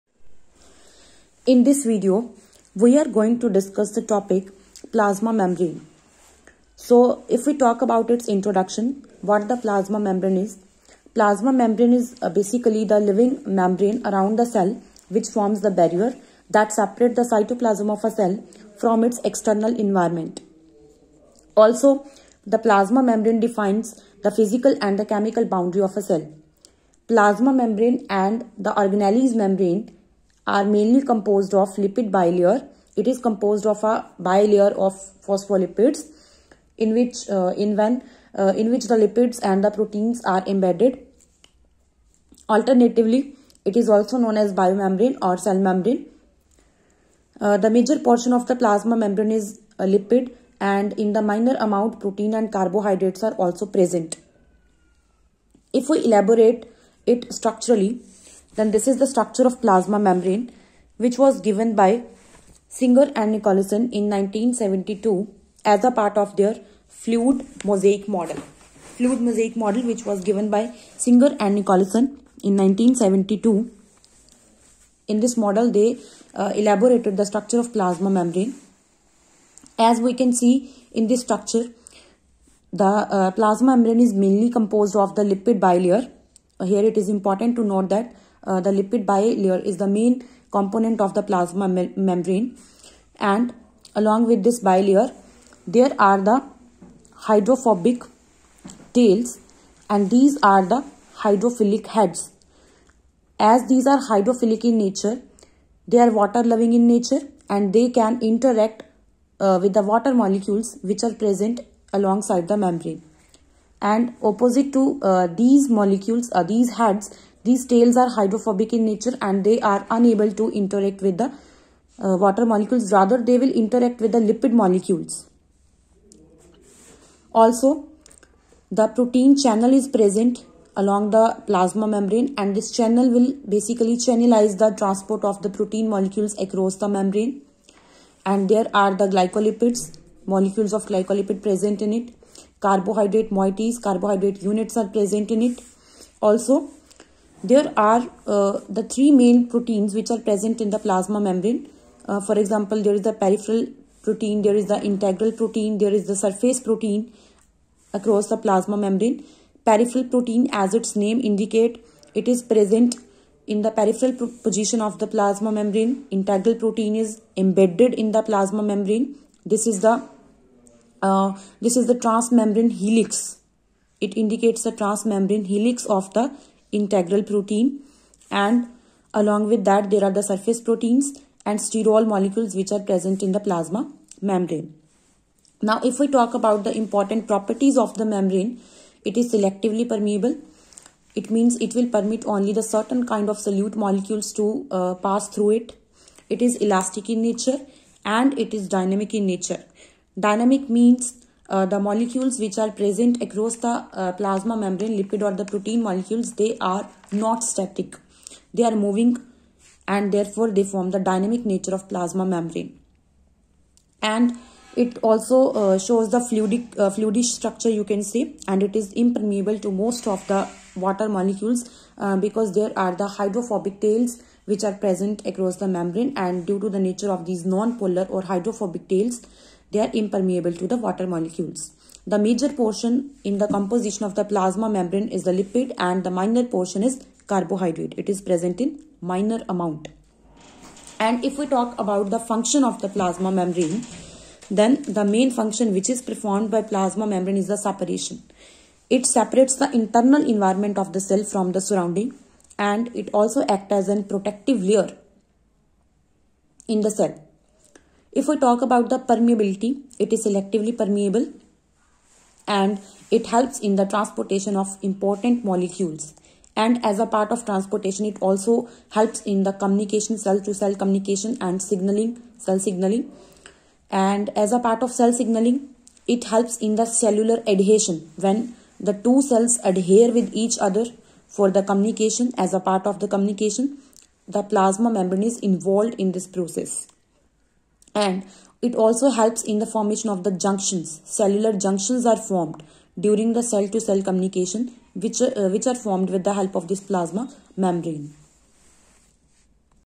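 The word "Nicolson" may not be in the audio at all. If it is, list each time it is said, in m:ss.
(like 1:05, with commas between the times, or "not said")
1:03, 1:11.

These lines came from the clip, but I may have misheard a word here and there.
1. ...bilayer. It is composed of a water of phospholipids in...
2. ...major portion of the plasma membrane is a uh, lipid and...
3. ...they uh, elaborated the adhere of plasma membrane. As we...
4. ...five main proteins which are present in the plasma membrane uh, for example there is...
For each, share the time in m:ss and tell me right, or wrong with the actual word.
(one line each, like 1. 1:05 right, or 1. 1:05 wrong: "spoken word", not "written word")
1. 0:32 wrong: "bilayer", not "water"
2. 0:47 right
3. 1:15 wrong: "structure", not "adhere"
4. 2:28 wrong: "three", not "five".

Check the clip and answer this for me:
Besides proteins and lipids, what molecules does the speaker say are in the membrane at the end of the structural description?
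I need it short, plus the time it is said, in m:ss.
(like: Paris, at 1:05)
sterol, at 3:01.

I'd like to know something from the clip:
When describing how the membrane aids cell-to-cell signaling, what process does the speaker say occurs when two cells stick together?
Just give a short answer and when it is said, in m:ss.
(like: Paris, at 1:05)
cellular adhesion, at 4:36.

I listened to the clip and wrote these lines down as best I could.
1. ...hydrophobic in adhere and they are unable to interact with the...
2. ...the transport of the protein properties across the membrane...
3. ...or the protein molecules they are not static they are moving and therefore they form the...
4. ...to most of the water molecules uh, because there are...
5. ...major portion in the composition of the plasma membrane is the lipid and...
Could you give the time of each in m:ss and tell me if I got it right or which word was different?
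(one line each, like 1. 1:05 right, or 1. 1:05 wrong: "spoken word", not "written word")
1. 1:58 wrong: "nature", not "adhere"
2. 2:14 wrong: "molecules", not "properties"
3. 3:25 right
4. 3:39 right
5. 3:52 right.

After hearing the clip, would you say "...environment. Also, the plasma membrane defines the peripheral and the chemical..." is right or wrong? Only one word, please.
wrong.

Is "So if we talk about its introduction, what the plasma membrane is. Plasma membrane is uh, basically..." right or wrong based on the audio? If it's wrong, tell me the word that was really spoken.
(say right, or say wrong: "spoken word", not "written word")
right.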